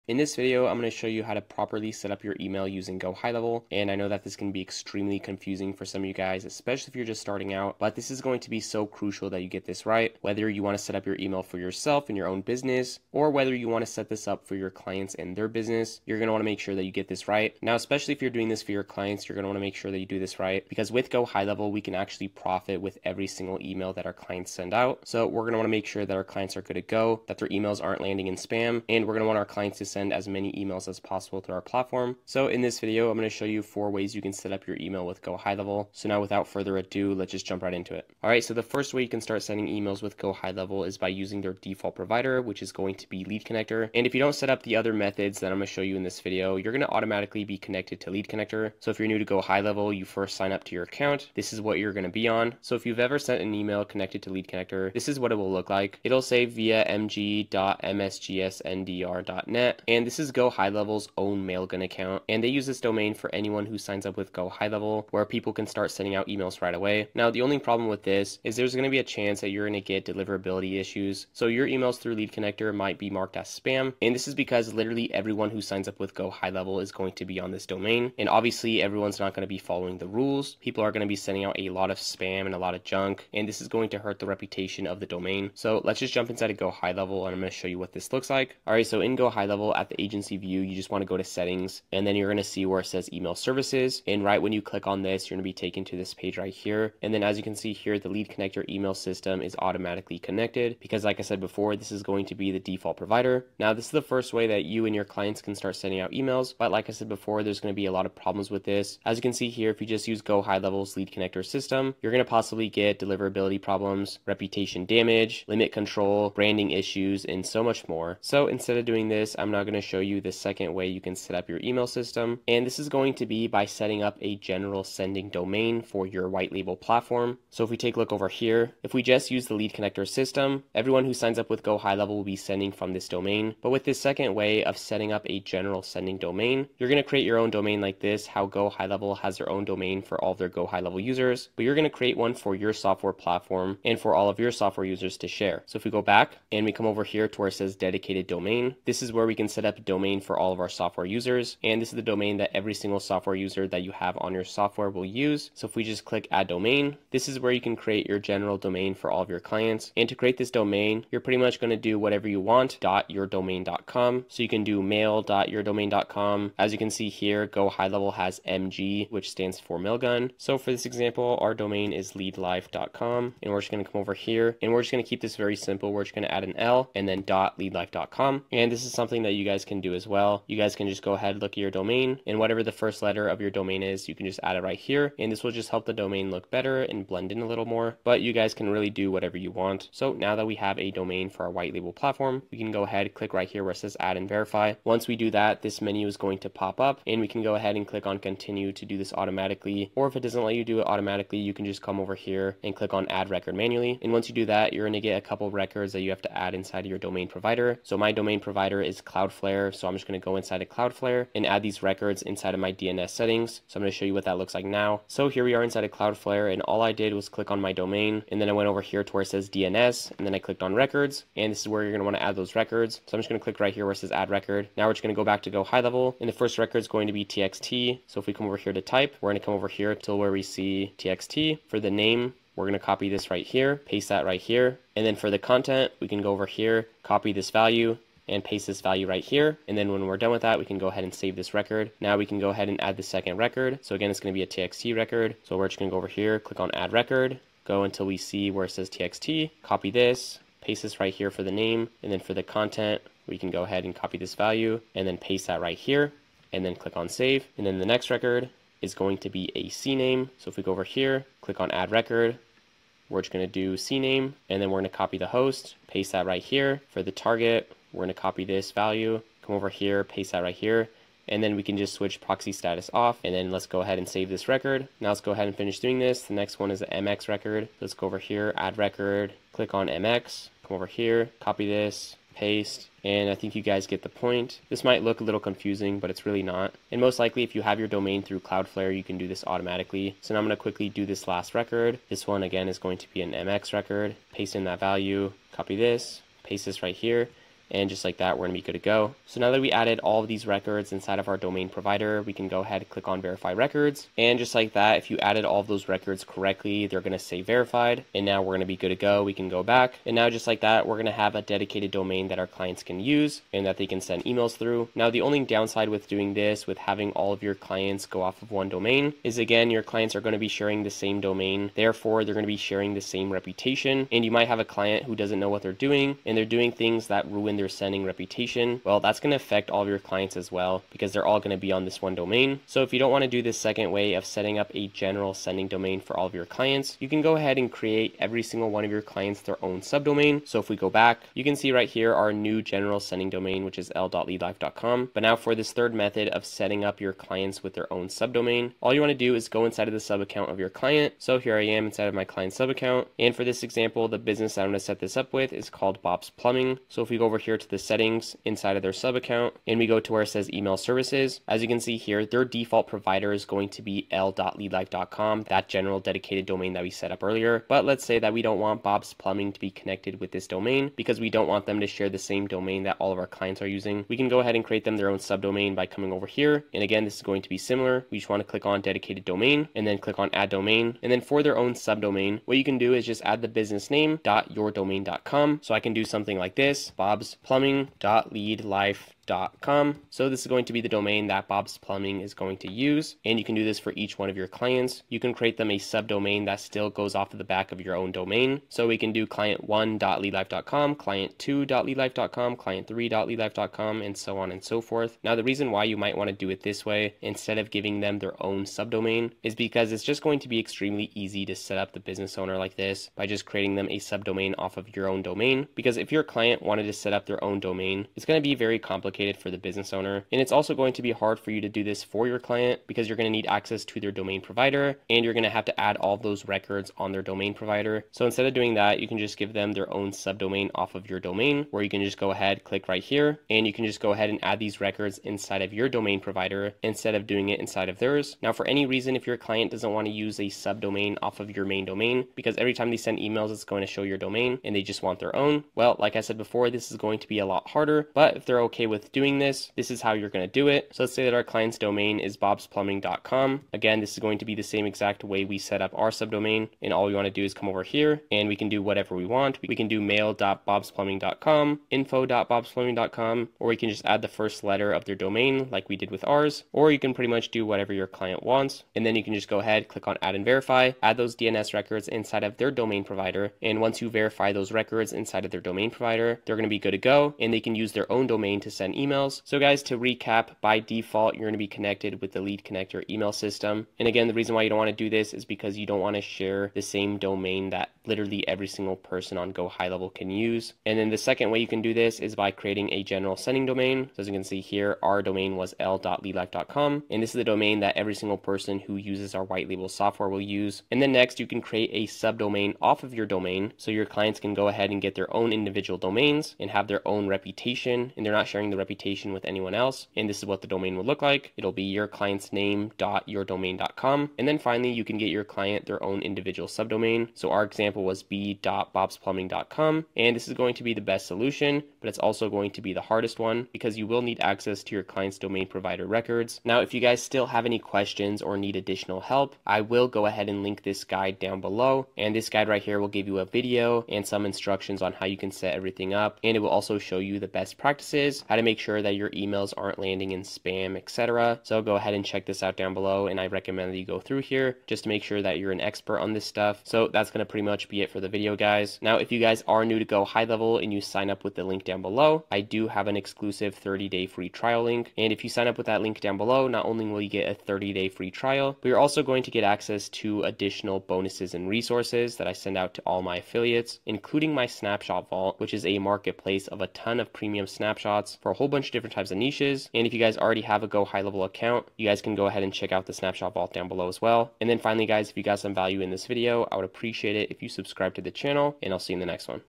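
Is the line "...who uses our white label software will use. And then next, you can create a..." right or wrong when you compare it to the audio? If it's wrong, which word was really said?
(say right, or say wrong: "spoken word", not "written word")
right.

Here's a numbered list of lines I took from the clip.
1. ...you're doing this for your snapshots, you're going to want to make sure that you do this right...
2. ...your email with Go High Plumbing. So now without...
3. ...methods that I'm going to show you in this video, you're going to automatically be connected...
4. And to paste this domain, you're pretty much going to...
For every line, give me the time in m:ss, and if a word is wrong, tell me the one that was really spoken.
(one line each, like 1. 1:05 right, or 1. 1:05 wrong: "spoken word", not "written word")
1. 0:18 wrong: "clients", not "snapshots"
2. 0:34 wrong: "Level", not "Plumbing"
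3. 0:44 right
4. 2:39 wrong: "create", not "paste".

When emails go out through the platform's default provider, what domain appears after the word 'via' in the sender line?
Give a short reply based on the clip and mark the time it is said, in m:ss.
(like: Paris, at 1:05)
mg.msgsndr.net, at 0:56.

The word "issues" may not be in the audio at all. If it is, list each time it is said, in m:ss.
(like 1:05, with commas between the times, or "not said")
1:10, 1:56.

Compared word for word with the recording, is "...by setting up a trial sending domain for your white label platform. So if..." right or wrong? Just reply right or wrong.
wrong.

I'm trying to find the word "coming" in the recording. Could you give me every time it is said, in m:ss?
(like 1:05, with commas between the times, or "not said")
6:15.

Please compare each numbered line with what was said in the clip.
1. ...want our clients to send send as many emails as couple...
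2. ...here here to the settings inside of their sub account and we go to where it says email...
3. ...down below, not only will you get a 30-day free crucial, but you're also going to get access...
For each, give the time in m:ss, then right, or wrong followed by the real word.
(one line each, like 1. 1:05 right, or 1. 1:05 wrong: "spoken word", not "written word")
1. 0:29 wrong: "possible", not "couple"
2. 5:57 right
3. 9:16 wrong: "trial", not "crucial".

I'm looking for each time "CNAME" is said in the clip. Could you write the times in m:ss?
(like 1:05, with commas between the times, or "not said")
4:19, 4:23.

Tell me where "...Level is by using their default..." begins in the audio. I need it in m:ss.
0:40.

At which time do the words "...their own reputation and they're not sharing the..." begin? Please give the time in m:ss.
8:26.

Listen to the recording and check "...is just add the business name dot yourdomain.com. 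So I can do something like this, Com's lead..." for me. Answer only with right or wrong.
wrong.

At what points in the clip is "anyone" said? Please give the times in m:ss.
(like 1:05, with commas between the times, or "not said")
1:03, 8:29.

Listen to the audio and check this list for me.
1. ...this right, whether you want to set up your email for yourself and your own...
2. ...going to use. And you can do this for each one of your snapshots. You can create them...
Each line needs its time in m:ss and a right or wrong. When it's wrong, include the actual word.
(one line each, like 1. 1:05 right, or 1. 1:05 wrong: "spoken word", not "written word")
1. 0:09 right
2. 6:32 wrong: "clients", not "snapshots".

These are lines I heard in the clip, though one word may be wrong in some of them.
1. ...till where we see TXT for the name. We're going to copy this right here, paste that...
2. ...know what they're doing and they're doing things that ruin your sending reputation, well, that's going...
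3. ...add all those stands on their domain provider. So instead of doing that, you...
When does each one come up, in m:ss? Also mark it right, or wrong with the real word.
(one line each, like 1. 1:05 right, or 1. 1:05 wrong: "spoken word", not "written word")
1. 3:49 right
2. 5:25 right
3. 7:05 wrong: "records", not "stands".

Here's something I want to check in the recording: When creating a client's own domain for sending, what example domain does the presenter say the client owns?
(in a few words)
bobsplumbing.com.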